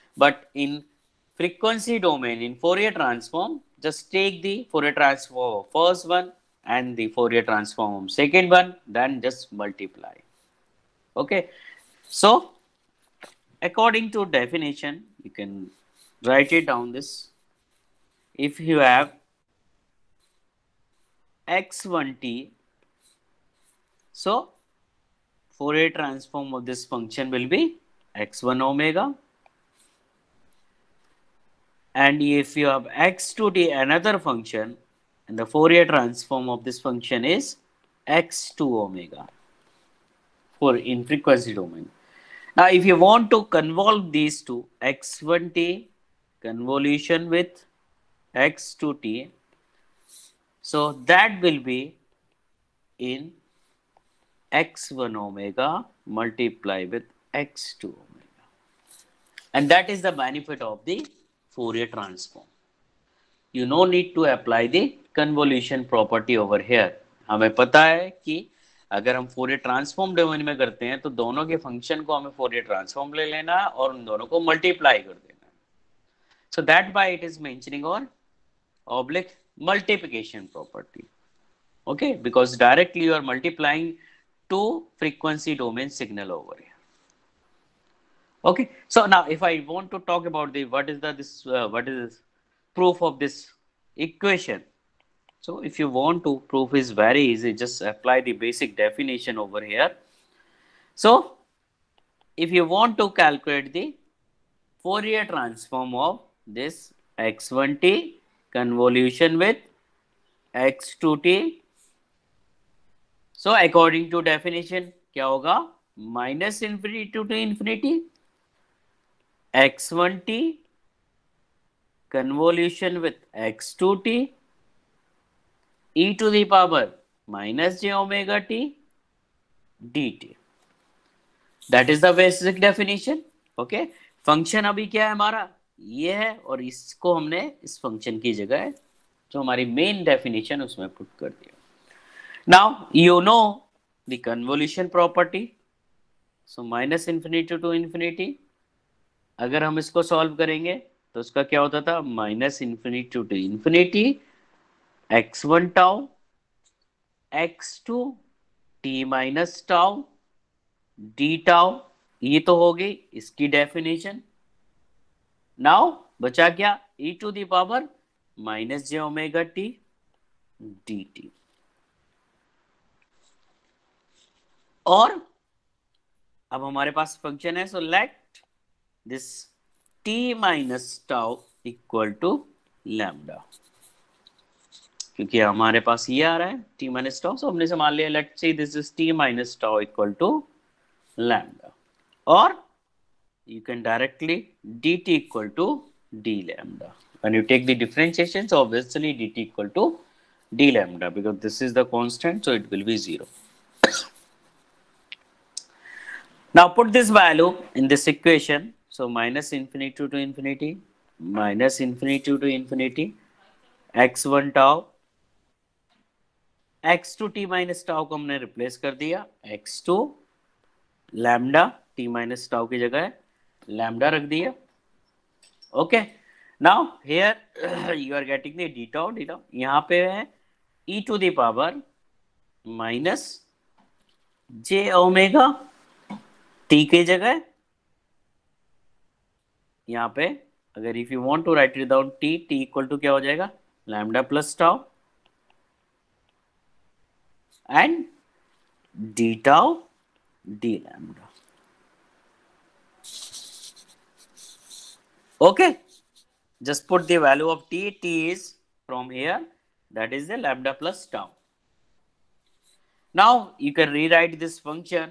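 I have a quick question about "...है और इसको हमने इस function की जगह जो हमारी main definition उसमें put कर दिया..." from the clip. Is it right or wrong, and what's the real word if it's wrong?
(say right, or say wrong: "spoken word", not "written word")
right.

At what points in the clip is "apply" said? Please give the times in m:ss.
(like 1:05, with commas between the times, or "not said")
1:04, 1:37.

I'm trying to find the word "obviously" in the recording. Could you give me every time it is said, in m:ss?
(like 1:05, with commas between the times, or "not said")
3:18.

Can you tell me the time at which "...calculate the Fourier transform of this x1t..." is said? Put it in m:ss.
1:43.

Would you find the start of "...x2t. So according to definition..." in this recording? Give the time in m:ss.
1:50.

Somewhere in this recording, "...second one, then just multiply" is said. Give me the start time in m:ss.
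0:08.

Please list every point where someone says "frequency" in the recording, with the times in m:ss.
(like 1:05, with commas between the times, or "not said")
0:01, 0:41.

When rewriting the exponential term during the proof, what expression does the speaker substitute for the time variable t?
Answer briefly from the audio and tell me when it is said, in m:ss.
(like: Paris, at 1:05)
lambda plus tau, at 4:20.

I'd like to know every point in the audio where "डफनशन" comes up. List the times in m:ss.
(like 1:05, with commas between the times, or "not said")
2:43.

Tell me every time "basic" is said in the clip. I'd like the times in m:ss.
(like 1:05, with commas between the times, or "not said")
1:38, 2:12.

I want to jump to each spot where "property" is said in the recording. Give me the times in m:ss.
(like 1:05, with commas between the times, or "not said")
1:05, 2:24.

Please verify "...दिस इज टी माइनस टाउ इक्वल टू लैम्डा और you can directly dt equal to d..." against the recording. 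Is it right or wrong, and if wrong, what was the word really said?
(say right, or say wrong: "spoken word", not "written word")
right.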